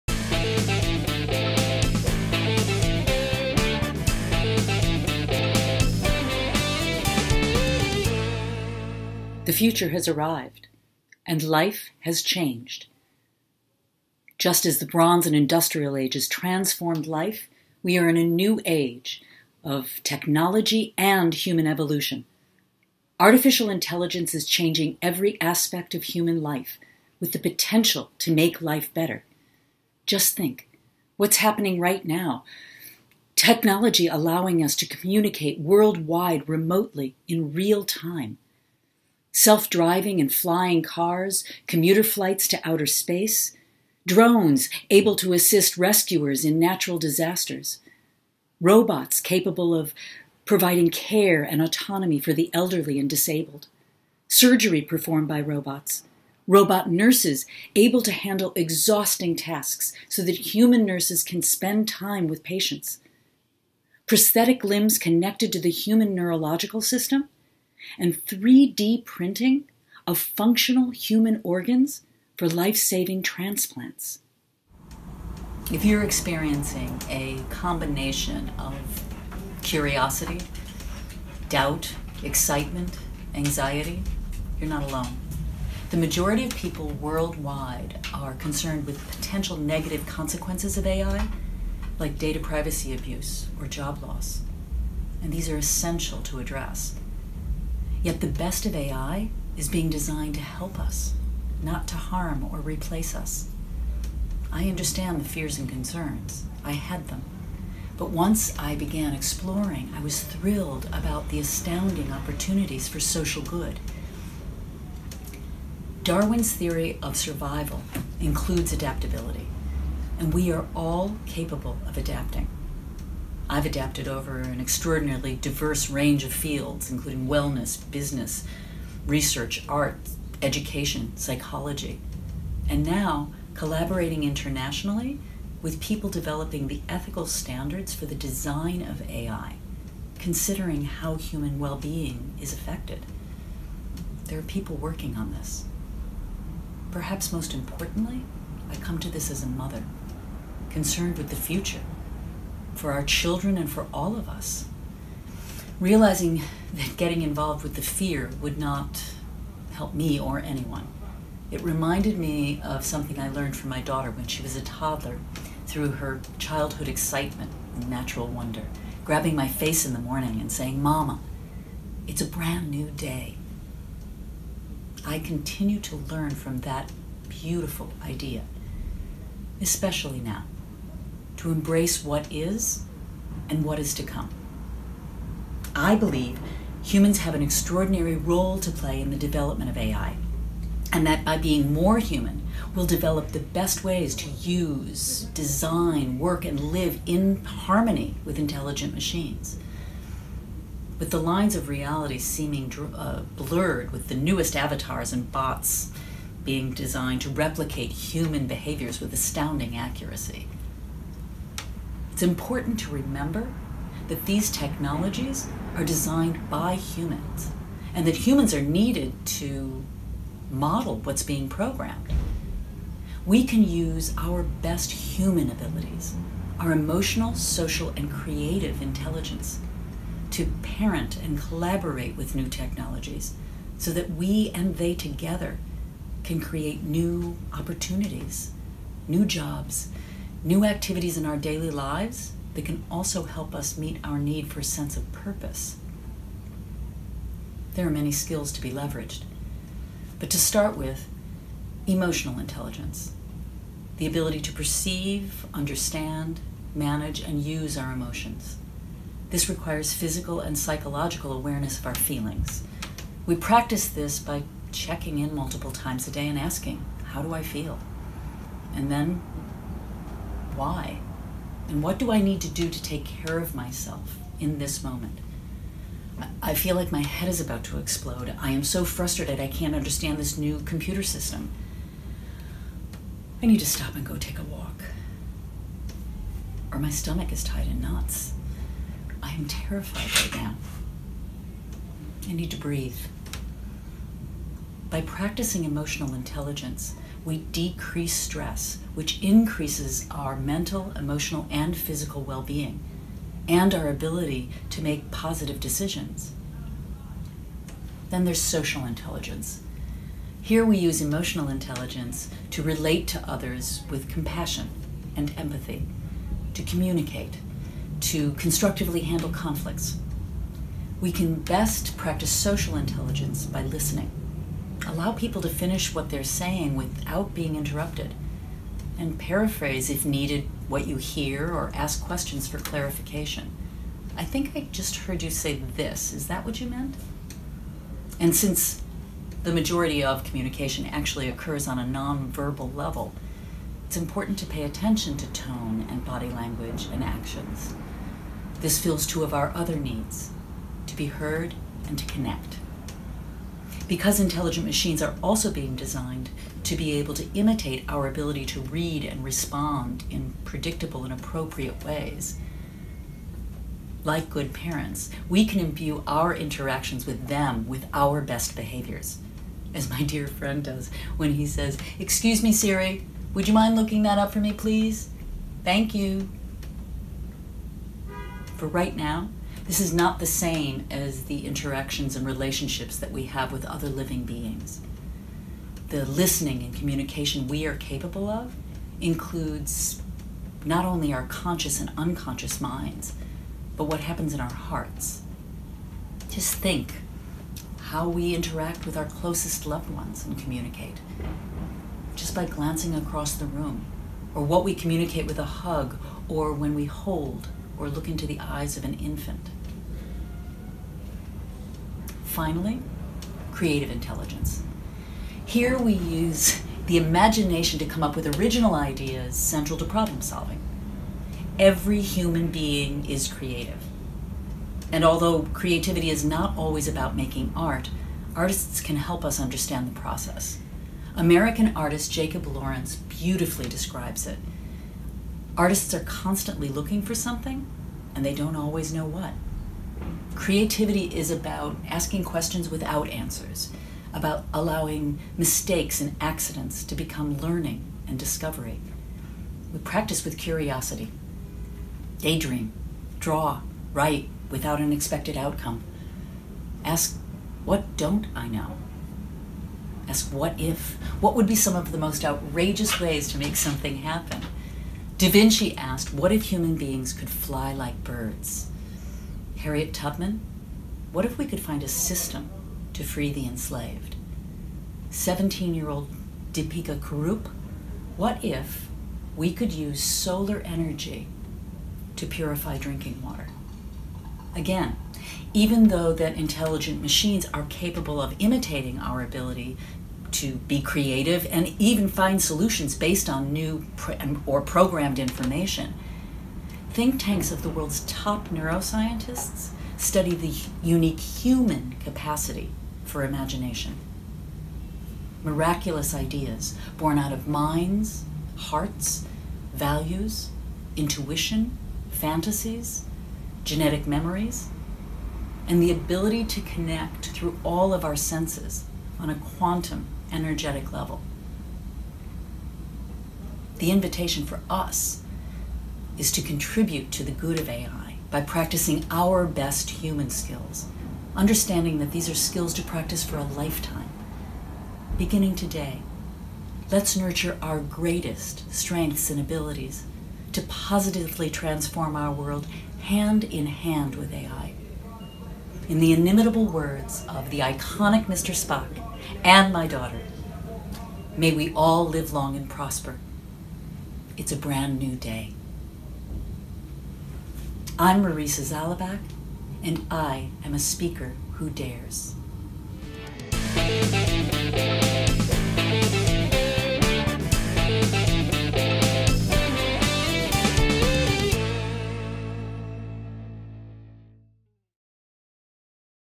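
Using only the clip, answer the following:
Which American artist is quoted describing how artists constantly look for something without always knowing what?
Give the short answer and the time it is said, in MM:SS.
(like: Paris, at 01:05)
Jacob Lawrence, at 07:12.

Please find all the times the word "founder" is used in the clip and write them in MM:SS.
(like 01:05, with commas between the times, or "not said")
not said.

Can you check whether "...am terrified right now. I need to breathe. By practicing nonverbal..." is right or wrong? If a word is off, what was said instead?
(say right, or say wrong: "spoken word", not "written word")
wrong: "emotional", not "nonverbal".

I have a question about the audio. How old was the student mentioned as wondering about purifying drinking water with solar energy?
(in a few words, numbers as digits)
17.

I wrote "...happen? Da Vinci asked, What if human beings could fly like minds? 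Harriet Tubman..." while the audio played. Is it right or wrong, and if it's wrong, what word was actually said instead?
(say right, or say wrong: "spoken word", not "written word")
wrong: "birds", not "minds".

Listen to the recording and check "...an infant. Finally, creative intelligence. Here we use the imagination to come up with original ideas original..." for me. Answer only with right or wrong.
wrong.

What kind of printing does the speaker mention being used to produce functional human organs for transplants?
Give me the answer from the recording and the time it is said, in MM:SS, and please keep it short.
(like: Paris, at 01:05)
3D printing, at 01:08.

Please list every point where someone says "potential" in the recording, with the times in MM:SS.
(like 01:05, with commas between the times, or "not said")
00:27, 01:29.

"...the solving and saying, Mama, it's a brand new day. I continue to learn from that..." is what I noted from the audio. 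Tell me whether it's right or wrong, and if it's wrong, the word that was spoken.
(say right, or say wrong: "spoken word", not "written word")
wrong: "morning", not "solving".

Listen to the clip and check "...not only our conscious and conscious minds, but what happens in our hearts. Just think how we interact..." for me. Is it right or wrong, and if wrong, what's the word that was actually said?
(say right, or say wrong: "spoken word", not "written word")
wrong: "unconscious", not "conscious".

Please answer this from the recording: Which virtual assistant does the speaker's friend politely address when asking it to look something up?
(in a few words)
Siri.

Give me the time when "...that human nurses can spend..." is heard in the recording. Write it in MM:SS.
01:00.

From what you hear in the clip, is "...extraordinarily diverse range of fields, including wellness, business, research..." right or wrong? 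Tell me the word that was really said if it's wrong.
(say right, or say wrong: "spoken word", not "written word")
right.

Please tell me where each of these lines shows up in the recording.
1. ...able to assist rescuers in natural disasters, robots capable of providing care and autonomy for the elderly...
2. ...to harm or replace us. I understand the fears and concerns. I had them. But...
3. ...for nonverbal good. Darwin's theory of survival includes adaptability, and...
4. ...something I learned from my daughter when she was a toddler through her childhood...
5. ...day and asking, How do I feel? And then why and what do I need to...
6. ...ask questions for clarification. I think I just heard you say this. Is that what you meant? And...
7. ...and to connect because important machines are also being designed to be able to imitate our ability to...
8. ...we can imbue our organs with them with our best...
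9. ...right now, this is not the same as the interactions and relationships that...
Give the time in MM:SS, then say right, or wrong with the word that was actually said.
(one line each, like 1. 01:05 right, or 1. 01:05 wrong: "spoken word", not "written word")
1. 00:44 right
2. 01:41 right
3. 01:52 wrong: "social", not "nonverbal"
4. 02:42 right
5. 04:26 right
6. 05:31 right
7. 05:51 wrong: "intelligent", not "important"
8. 06:05 wrong: "interactions", not "organs"
9. 06:18 right.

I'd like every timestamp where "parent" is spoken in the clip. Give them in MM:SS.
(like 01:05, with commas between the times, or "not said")
03:50, 06:04.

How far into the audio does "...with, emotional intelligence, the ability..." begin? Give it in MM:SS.
04:10.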